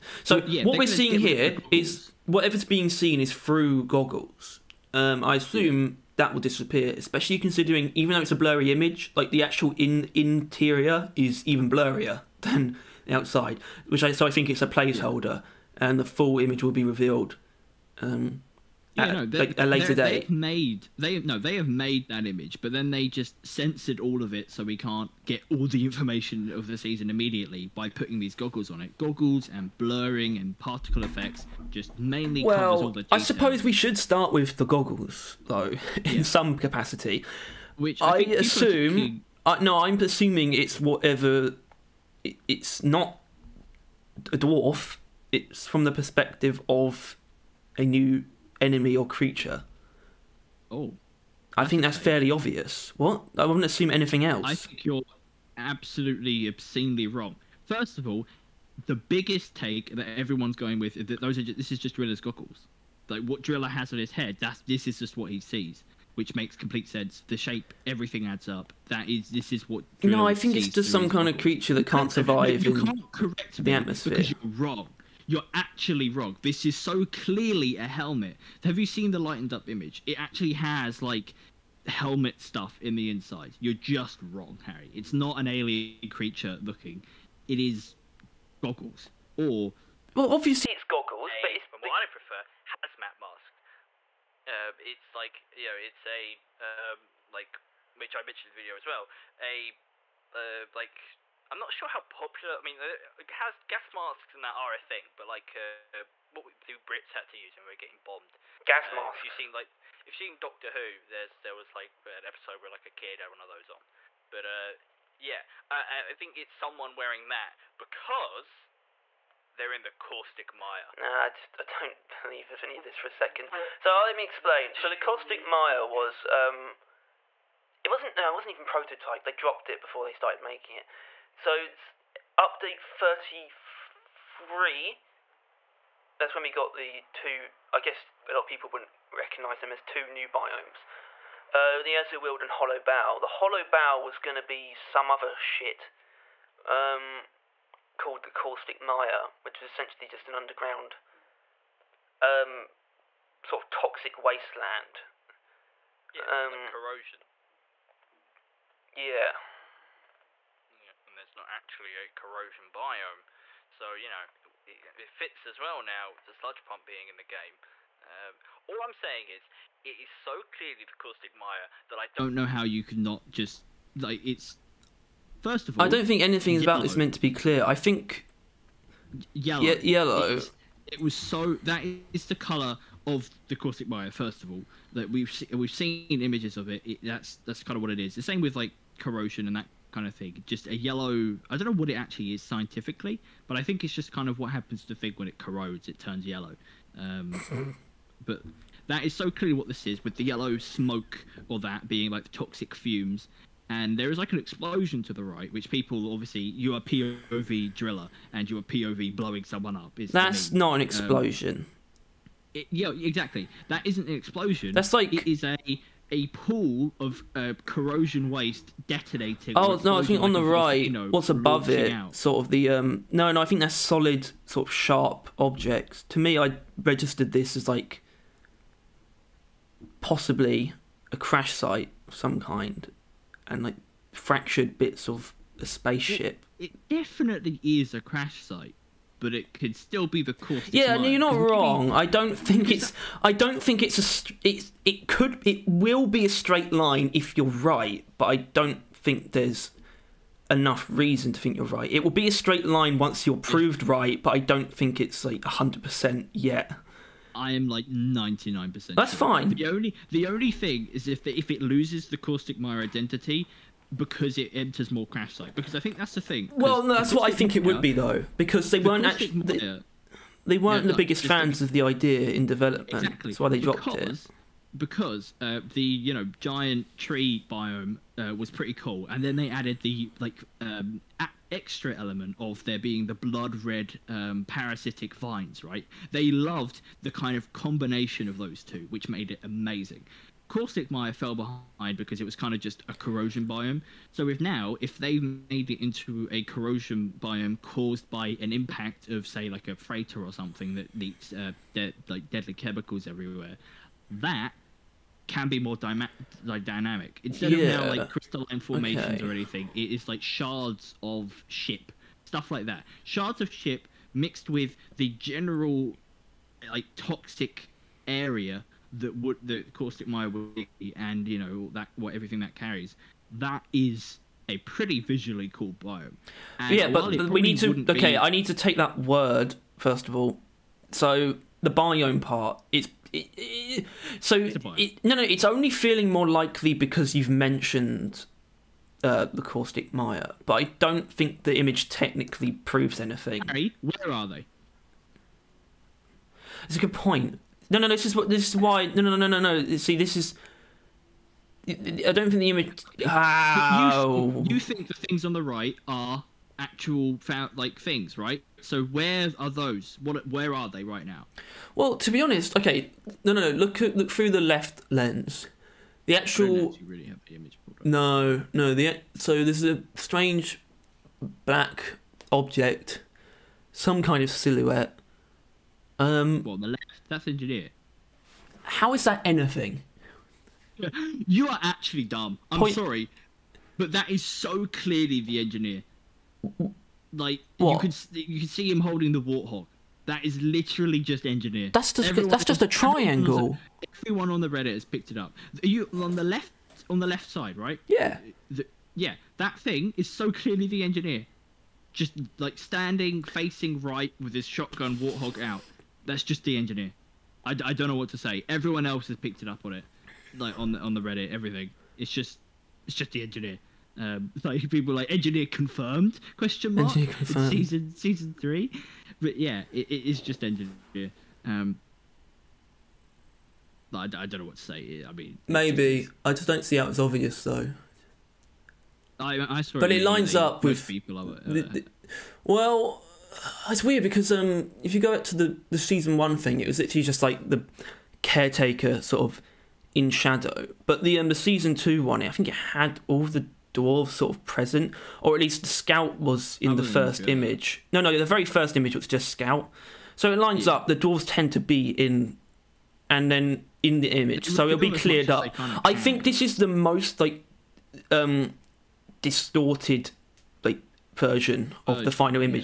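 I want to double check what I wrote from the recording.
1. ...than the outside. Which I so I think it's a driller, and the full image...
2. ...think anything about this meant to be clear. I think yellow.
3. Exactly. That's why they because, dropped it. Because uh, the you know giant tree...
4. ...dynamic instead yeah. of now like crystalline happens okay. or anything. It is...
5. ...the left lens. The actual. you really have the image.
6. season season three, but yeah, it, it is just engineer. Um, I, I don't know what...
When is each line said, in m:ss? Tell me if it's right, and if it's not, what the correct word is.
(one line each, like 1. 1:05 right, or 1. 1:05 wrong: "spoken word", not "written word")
1. 0:12 wrong: "placeholder", not "driller"
2. 2:56 right
3. 4:32 right
4. 5:06 wrong: "formations", not "happens"
5. 6:04 right
6. 6:57 right.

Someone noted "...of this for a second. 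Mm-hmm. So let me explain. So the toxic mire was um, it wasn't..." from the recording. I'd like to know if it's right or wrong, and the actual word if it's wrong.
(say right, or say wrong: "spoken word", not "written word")
wrong: "caustic", not "toxic".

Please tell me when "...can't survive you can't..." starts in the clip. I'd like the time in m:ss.
1:11.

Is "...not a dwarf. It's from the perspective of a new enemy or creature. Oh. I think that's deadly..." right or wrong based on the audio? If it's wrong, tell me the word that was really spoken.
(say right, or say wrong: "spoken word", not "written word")
wrong: "fairly", not "deadly".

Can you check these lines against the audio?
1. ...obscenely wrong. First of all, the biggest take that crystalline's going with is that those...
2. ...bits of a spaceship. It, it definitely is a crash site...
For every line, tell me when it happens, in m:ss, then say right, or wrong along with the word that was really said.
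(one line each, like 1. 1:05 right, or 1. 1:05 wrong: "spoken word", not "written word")
1. 0:56 wrong: "everyone", not "crystalline"
2. 3:54 right.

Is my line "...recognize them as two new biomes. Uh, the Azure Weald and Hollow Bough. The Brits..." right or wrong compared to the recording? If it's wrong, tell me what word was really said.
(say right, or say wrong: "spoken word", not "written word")
wrong: "Hollow", not "Brits".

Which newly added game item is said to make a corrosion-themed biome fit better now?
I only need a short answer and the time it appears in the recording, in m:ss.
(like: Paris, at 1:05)
sludge pump, at 2:46.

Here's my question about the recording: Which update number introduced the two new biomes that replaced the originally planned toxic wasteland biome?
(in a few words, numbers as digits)
33.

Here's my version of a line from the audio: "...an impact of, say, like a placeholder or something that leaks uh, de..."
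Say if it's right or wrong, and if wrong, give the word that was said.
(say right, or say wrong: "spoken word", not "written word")
wrong: "freighter", not "placeholder".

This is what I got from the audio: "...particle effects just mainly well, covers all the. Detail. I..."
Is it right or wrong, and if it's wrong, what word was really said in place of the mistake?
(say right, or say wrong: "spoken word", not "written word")
right.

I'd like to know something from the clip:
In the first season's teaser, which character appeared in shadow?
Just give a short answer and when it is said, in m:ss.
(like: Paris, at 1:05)
the caretaker, at 7:18.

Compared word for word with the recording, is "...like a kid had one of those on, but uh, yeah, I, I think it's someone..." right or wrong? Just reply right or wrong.
right.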